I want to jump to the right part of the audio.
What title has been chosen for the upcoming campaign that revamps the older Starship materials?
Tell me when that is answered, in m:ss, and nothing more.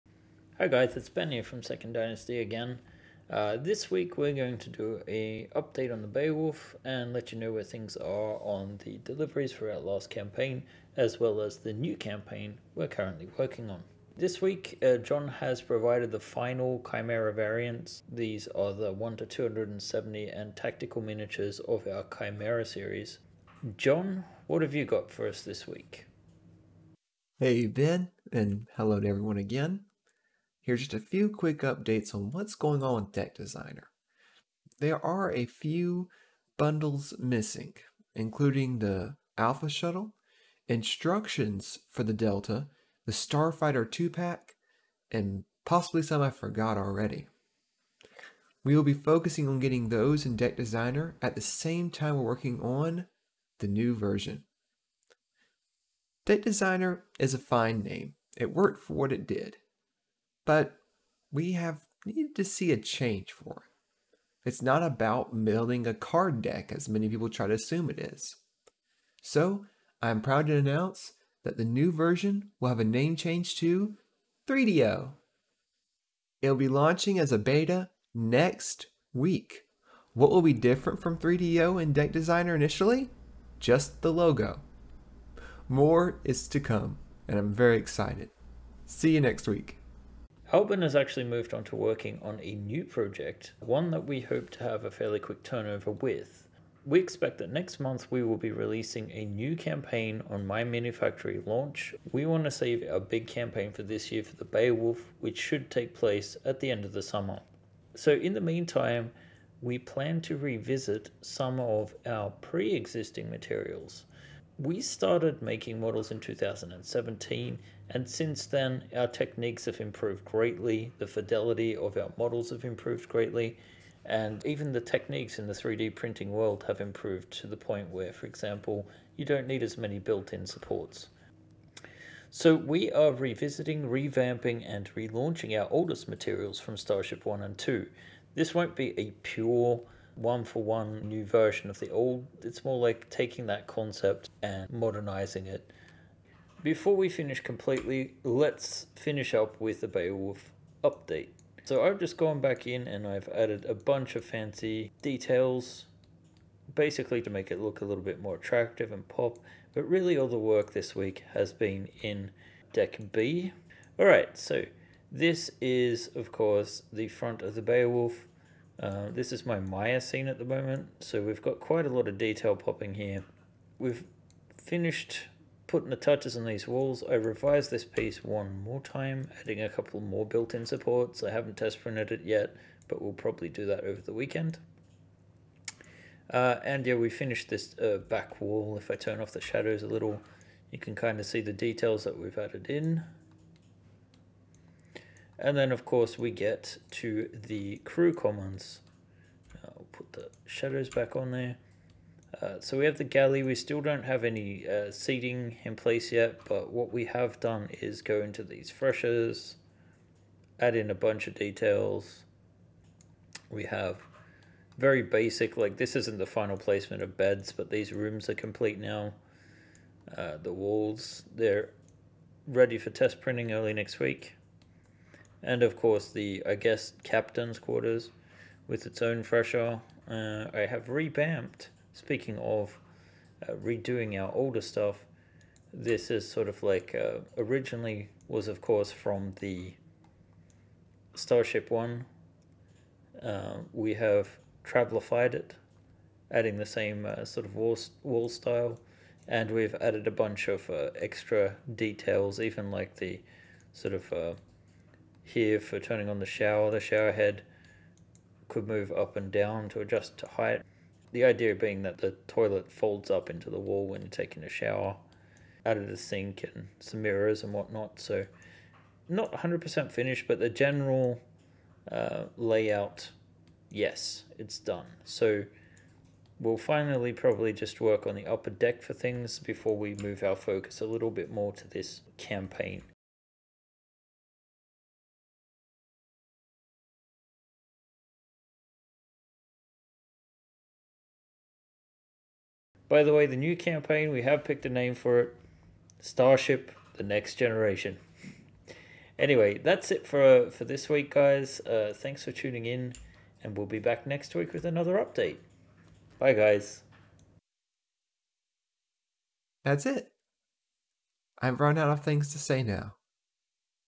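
4:56.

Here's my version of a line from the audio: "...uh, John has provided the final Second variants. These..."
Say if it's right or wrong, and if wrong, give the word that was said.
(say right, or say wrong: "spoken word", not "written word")
wrong: "Chimera", not "Second".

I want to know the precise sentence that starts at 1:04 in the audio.
It's not about building a card deck as many people try to assume it is.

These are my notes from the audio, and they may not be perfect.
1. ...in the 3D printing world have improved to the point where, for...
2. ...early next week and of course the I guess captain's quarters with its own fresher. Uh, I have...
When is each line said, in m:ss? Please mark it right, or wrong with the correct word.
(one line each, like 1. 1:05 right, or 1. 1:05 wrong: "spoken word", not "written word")
1. 2:05 right
2. 3:43 right.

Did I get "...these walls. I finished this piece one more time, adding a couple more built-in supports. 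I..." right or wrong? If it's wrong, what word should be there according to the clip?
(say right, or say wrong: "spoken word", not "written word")
wrong: "revised", not "finished".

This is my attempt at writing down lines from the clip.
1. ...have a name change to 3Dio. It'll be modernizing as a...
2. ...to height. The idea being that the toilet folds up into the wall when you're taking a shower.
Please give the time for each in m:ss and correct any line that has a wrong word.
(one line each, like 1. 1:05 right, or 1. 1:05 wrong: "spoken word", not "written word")
1. 1:12 wrong: "launching", not "modernizing"
2. 4:20 right.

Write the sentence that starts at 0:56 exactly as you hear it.
Deck Designer is a fine name.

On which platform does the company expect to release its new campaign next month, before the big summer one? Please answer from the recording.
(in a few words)
My Mini Factory.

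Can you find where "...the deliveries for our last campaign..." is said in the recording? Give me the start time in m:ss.
0:08.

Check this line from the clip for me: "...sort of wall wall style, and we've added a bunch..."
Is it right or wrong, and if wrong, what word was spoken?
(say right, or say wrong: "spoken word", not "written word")
right.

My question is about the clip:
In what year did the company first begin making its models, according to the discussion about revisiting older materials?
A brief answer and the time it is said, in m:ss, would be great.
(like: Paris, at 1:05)
2017, at 1:56.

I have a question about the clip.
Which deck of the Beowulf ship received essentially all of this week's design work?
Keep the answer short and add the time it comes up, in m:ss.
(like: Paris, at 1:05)
Deck B, at 2:42.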